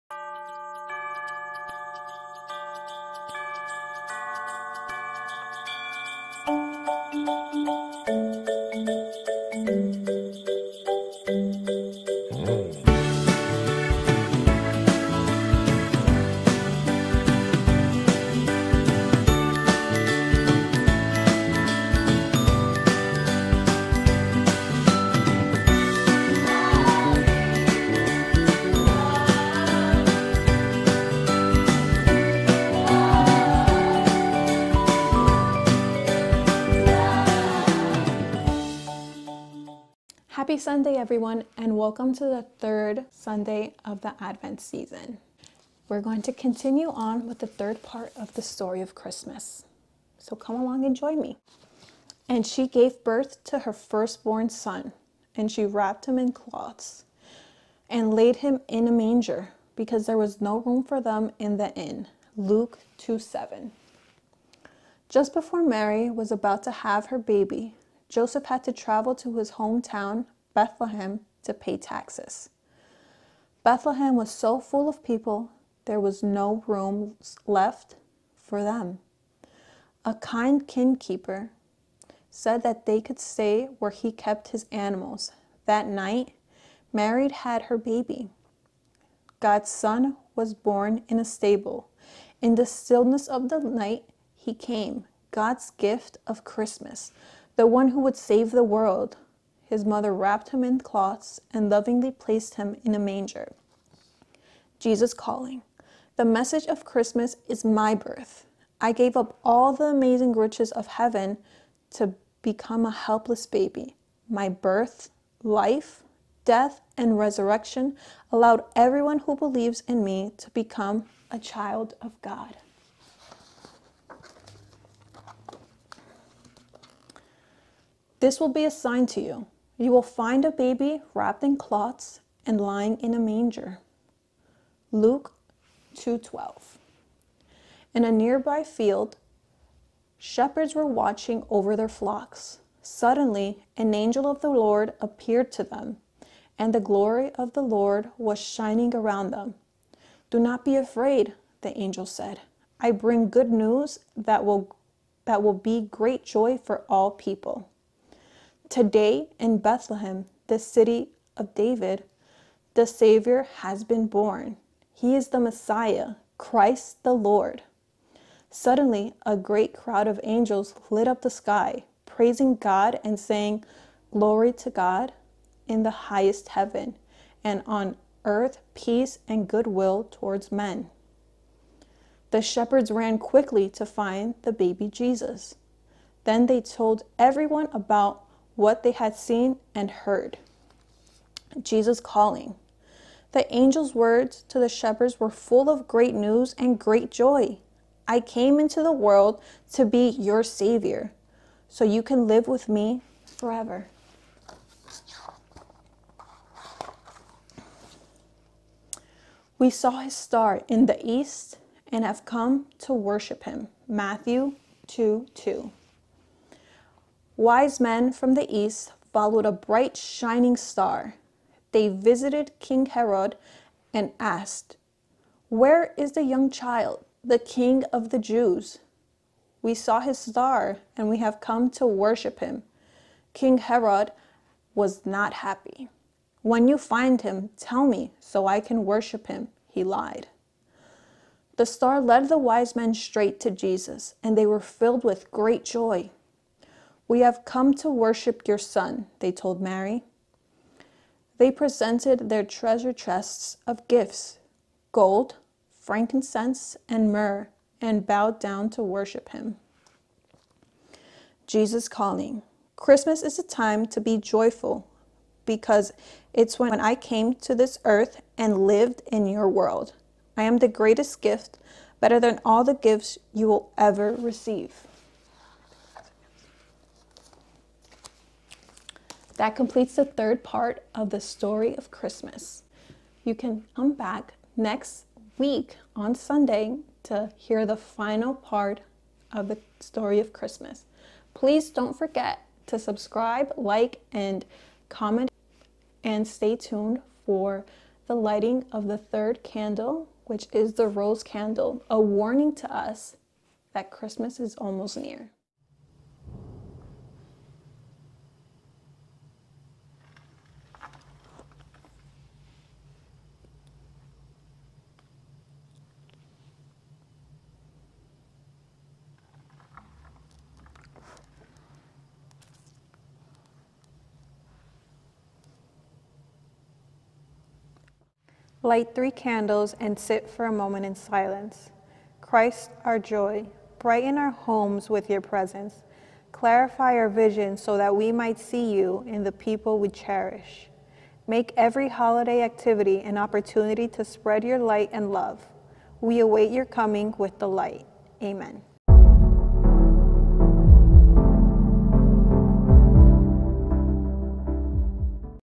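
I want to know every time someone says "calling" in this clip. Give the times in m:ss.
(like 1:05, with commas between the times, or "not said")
1:45, 3:11, 4:21.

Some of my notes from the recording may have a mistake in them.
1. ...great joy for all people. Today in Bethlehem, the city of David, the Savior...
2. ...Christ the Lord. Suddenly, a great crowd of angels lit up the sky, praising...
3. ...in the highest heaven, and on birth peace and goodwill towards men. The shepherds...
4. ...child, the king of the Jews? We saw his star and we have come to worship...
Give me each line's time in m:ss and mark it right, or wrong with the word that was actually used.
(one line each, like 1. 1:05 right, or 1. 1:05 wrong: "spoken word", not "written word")
1. 2:35 right
2. 2:46 right
3. 2:55 wrong: "earth", not "birth"
4. 3:46 right.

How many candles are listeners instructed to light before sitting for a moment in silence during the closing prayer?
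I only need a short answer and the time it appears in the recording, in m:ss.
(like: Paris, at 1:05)
3, at 5:28.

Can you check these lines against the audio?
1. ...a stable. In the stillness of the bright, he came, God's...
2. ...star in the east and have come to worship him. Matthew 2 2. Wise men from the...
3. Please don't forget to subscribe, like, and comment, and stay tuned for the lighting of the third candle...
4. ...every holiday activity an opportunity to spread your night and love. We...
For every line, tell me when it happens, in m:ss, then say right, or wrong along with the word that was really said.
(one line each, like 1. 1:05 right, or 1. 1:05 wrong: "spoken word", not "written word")
1. 1:31 wrong: "night", not "bright"
2. 3:30 right
3. 4:51 right
4. 5:41 wrong: "light", not "night".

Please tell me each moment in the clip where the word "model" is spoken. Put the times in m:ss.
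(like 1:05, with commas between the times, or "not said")
not said.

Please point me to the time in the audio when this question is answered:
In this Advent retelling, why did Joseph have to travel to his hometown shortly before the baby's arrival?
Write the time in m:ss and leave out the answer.
1:11.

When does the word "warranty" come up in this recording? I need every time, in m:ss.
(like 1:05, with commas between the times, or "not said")
not said.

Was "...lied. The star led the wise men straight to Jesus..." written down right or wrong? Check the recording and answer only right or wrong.
right.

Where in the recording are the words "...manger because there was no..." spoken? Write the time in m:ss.
0:58.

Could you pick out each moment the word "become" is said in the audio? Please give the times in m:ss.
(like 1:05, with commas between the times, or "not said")
1:52, 2:00.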